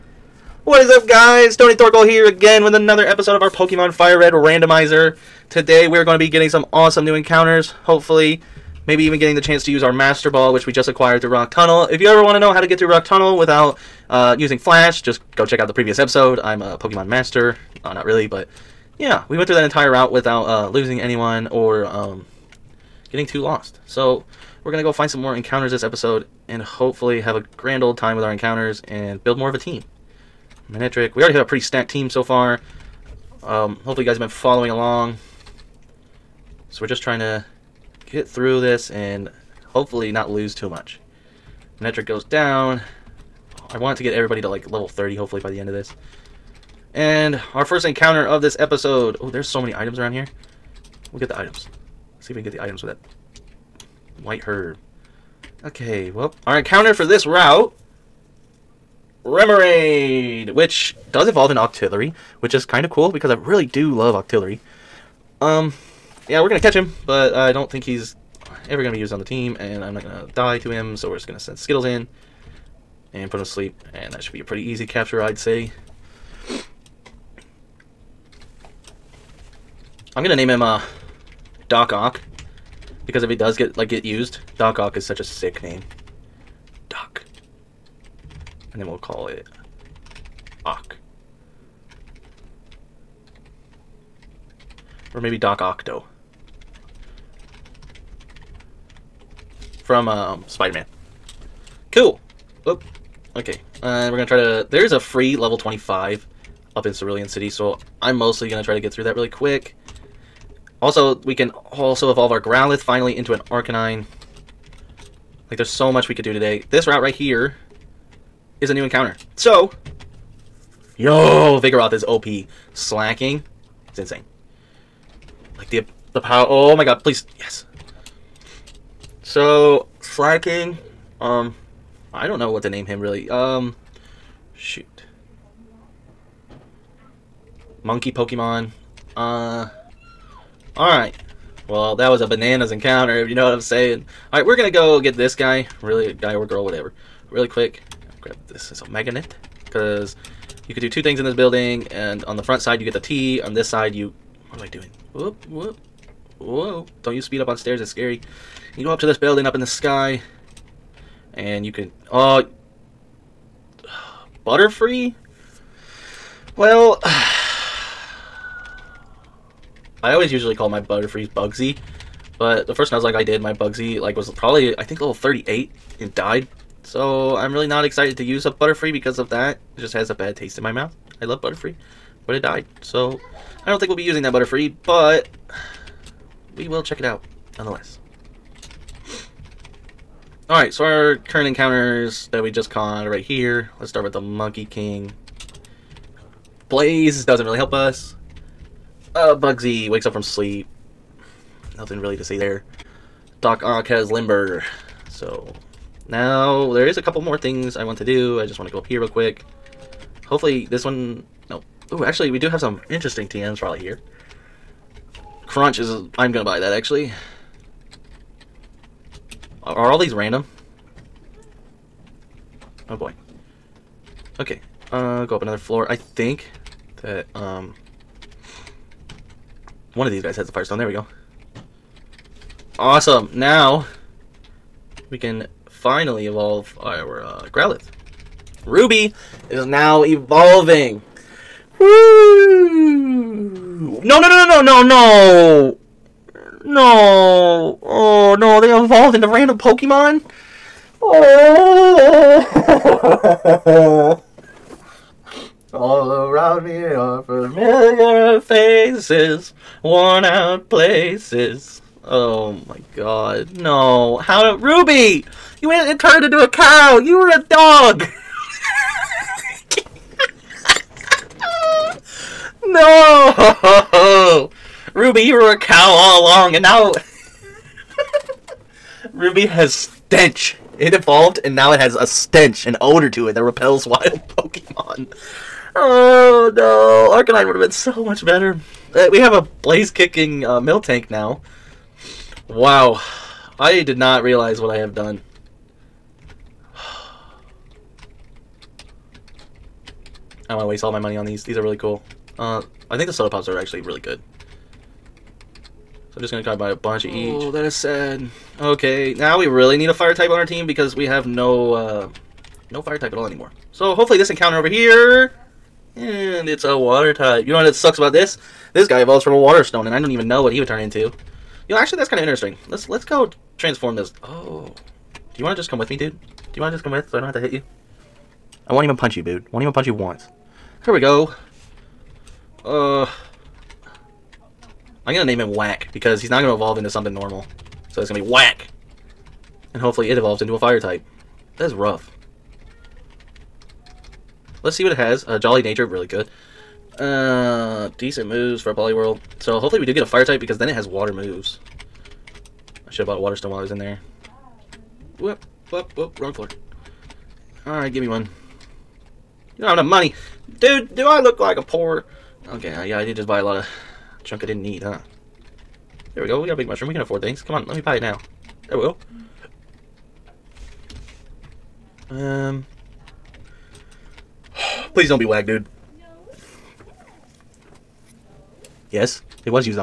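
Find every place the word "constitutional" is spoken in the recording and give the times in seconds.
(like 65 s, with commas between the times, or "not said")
not said.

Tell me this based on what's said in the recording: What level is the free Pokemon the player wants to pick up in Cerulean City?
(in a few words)
25.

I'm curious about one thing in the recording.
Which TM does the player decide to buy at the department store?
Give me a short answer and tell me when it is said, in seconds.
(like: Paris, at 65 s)
Crunch, at 215 s.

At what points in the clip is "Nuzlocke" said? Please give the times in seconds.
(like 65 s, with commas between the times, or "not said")
172 s.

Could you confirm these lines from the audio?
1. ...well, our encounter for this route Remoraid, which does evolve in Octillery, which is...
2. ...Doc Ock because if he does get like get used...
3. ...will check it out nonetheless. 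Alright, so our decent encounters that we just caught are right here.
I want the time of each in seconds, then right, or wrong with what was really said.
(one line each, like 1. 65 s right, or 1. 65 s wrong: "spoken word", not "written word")
1. 56 s right
2. 81 s right
3. 186 s wrong: "current", not "decent".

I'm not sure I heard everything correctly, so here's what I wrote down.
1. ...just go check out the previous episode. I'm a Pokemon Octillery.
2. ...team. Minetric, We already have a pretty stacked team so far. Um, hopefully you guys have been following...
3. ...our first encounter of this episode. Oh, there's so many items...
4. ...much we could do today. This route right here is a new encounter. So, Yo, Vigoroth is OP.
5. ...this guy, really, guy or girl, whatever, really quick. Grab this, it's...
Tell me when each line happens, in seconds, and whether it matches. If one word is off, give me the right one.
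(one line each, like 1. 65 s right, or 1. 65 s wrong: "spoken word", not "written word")
1. 15 s wrong: "Master", not "Octillery"
2. 29 s right
3. 47 s right
4. 115 s right
5. 145 s right.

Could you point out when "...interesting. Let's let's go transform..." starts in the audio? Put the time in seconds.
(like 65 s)
322 s.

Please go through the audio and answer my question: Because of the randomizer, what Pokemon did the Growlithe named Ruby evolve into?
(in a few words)
Miltank.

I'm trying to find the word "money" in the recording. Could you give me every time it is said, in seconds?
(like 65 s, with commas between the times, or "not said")
300 s, 359 s.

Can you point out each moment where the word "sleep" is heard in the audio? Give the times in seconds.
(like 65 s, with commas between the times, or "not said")
73 s, 200 s.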